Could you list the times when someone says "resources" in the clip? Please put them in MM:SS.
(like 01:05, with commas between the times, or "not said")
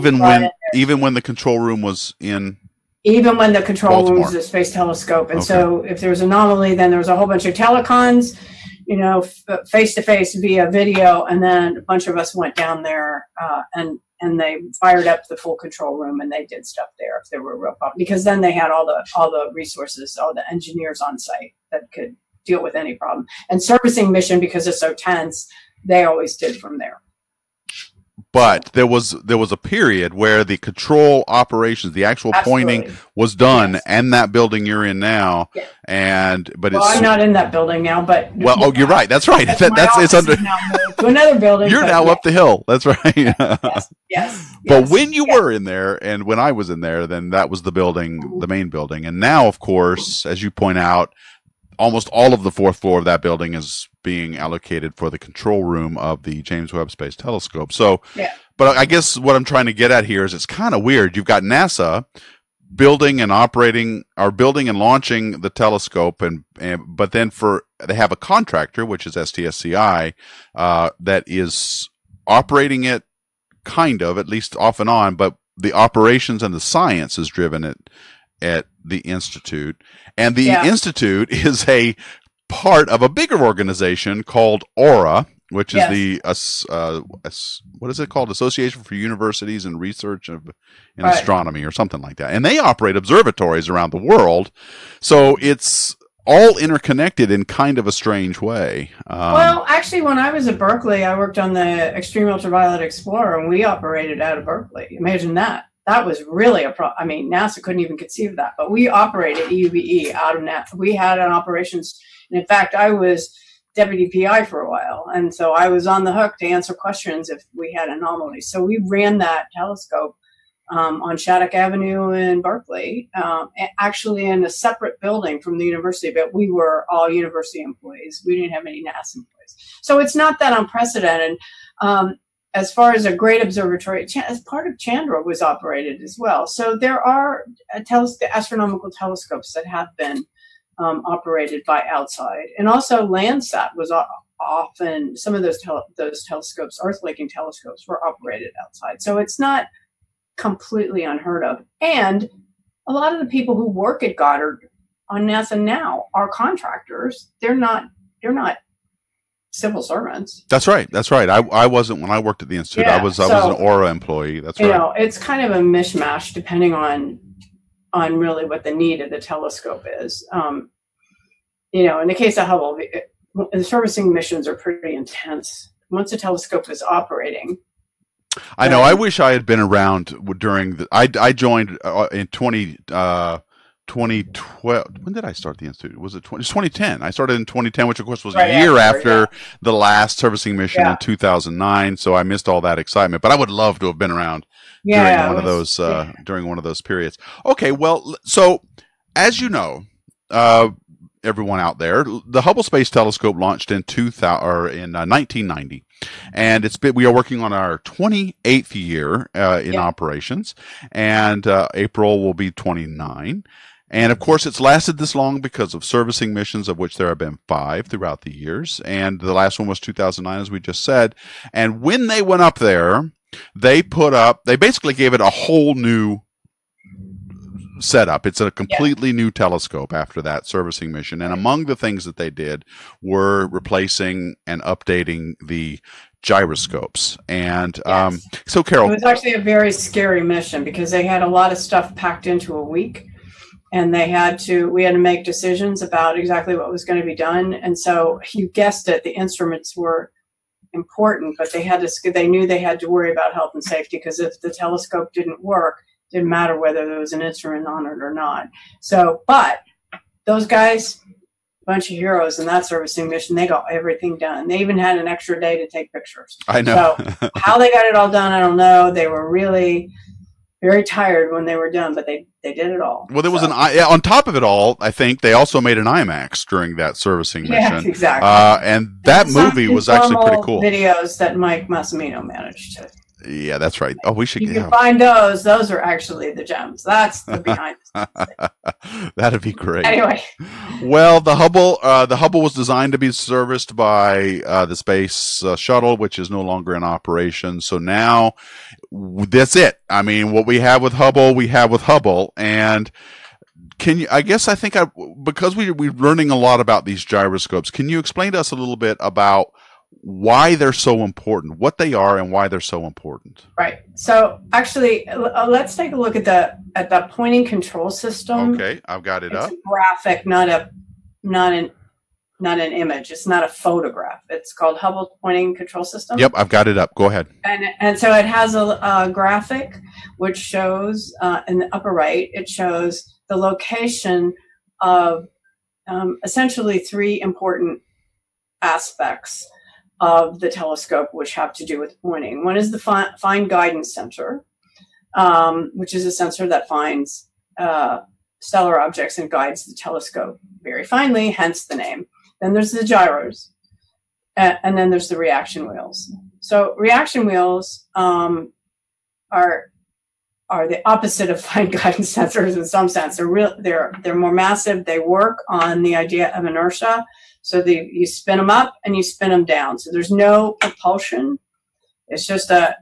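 00:19.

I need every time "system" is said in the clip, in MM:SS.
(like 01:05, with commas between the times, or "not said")
05:17, 05:25.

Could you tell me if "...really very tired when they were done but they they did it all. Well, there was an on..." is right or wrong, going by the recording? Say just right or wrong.
right.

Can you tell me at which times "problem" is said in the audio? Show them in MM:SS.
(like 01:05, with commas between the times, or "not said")
00:17, 00:22, 01:46.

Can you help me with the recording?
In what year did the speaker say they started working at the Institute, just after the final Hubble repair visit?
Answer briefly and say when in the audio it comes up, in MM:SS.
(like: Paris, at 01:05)
2010, at 03:07.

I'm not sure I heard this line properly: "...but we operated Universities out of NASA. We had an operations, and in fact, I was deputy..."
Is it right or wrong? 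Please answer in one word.
wrong.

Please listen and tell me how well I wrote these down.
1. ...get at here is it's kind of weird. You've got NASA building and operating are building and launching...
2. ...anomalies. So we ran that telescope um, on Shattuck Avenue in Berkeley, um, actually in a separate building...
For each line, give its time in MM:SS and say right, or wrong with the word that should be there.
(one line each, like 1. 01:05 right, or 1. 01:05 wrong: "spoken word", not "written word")
1. 00:59 right
2. 01:57 right.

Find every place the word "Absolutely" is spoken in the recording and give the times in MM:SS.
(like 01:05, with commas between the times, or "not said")
00:32.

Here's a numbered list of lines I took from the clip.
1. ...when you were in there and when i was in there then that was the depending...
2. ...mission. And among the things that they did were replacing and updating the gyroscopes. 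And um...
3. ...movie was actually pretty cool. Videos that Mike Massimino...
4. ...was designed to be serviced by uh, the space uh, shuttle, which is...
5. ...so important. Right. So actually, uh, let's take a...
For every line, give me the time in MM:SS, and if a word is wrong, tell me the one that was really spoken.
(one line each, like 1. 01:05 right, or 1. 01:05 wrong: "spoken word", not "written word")
1. 00:44 wrong: "building", not "depending"
2. 03:50 right
3. 04:39 right
4. 04:52 right
5. 05:12 right.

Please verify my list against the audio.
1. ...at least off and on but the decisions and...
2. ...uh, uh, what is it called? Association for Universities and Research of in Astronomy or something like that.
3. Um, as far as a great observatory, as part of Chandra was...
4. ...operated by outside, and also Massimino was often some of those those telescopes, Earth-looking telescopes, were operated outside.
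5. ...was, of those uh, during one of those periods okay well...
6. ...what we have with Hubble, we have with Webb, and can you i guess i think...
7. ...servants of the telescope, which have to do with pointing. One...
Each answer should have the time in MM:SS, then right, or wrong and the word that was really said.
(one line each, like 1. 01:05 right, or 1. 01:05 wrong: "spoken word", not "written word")
1. 01:14 wrong: "operations", not "decisions"
2. 01:26 right
3. 02:11 right
4. 02:21 wrong: "Landsat", not "Massimino"
5. 03:15 right
6. 05:00 wrong: "Hubble", not "Webb"
7. 05:38 wrong: "aspects", not "servants".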